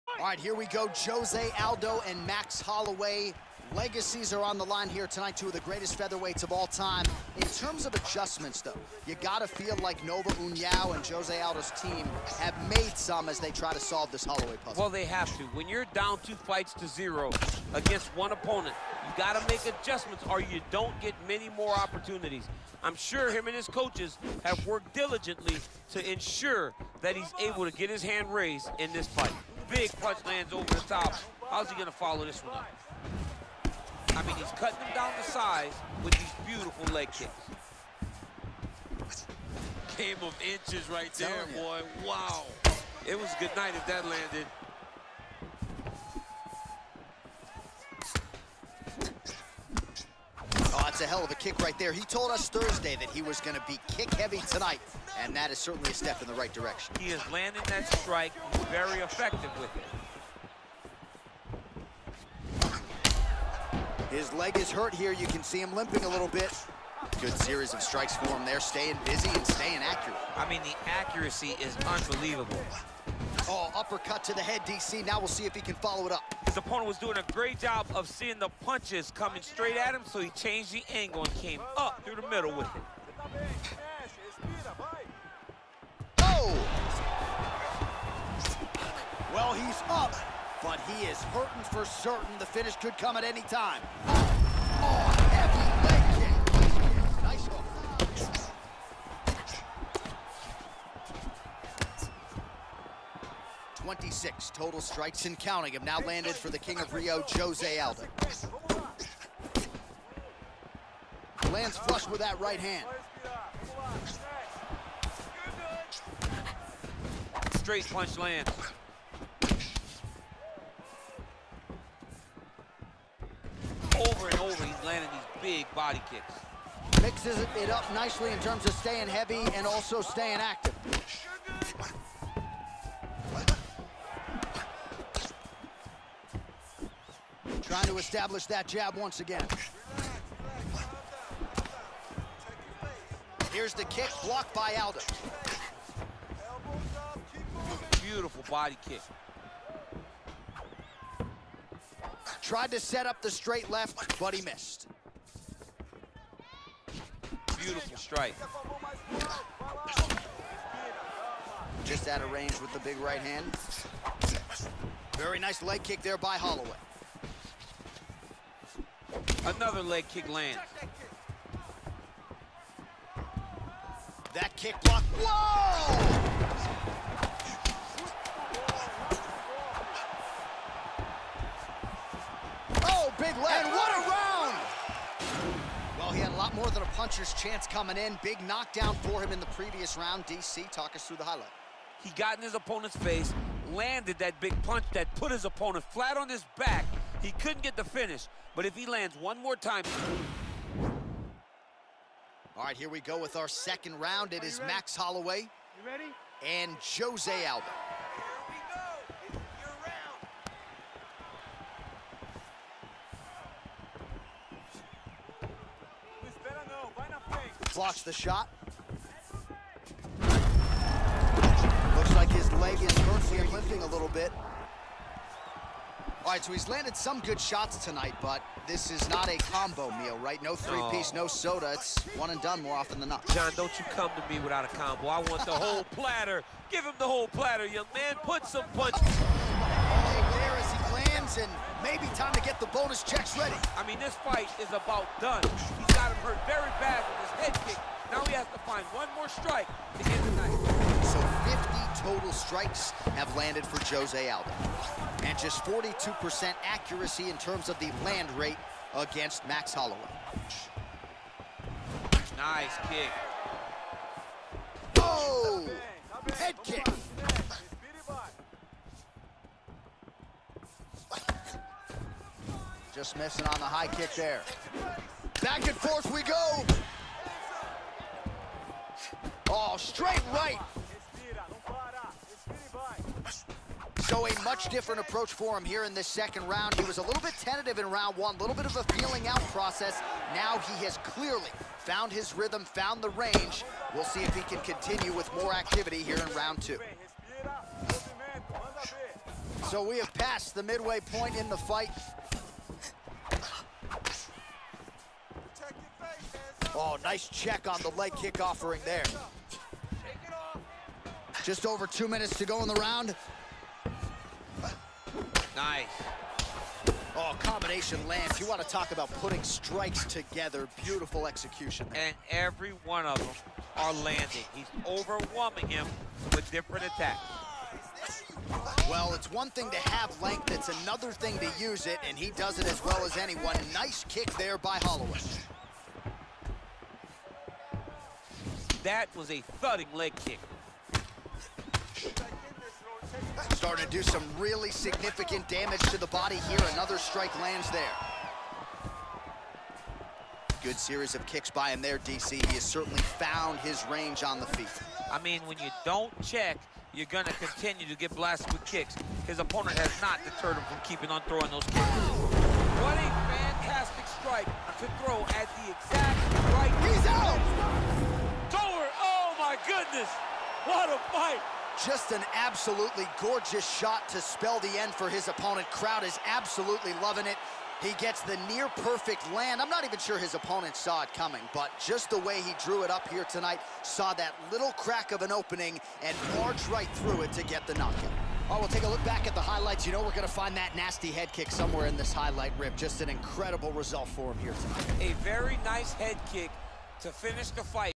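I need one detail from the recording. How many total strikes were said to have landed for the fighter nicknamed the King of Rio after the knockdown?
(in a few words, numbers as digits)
26.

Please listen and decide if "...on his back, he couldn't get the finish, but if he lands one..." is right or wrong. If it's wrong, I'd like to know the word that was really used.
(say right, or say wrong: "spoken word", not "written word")
right.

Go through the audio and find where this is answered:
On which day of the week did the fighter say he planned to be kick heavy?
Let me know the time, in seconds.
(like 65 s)
52 s.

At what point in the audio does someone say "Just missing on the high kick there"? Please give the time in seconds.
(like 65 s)
272 s.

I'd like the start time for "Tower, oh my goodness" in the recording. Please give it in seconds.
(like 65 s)
368 s.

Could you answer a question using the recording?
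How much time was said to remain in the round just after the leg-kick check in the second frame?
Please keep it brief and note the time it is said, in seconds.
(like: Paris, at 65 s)
just over 2 minutes, at 311 s.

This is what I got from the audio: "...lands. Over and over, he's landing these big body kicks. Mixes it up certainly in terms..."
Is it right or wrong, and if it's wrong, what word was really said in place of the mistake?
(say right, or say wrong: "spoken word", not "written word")
wrong: "nicely", not "certainly".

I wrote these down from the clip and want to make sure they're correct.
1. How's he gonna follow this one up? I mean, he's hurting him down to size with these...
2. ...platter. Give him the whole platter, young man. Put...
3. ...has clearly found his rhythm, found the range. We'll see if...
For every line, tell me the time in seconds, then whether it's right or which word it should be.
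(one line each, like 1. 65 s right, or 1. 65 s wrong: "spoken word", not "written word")
1. 31 s wrong: "cutting", not "hurting"
2. 235 s right
3. 290 s right.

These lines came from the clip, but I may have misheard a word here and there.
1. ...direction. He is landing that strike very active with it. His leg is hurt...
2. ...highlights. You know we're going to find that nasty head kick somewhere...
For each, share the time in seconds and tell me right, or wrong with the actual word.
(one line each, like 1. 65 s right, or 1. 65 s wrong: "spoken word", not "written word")
1. 56 s wrong: "effective", not "active"
2. 389 s right.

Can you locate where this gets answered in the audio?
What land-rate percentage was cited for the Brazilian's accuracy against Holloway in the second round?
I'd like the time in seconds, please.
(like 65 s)
255 s.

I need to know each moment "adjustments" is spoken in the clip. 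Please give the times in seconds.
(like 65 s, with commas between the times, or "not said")
7 s, 19 s.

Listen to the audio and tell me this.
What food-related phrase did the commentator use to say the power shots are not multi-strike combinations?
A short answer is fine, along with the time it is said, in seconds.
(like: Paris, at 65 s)
combo meal, at 229 s.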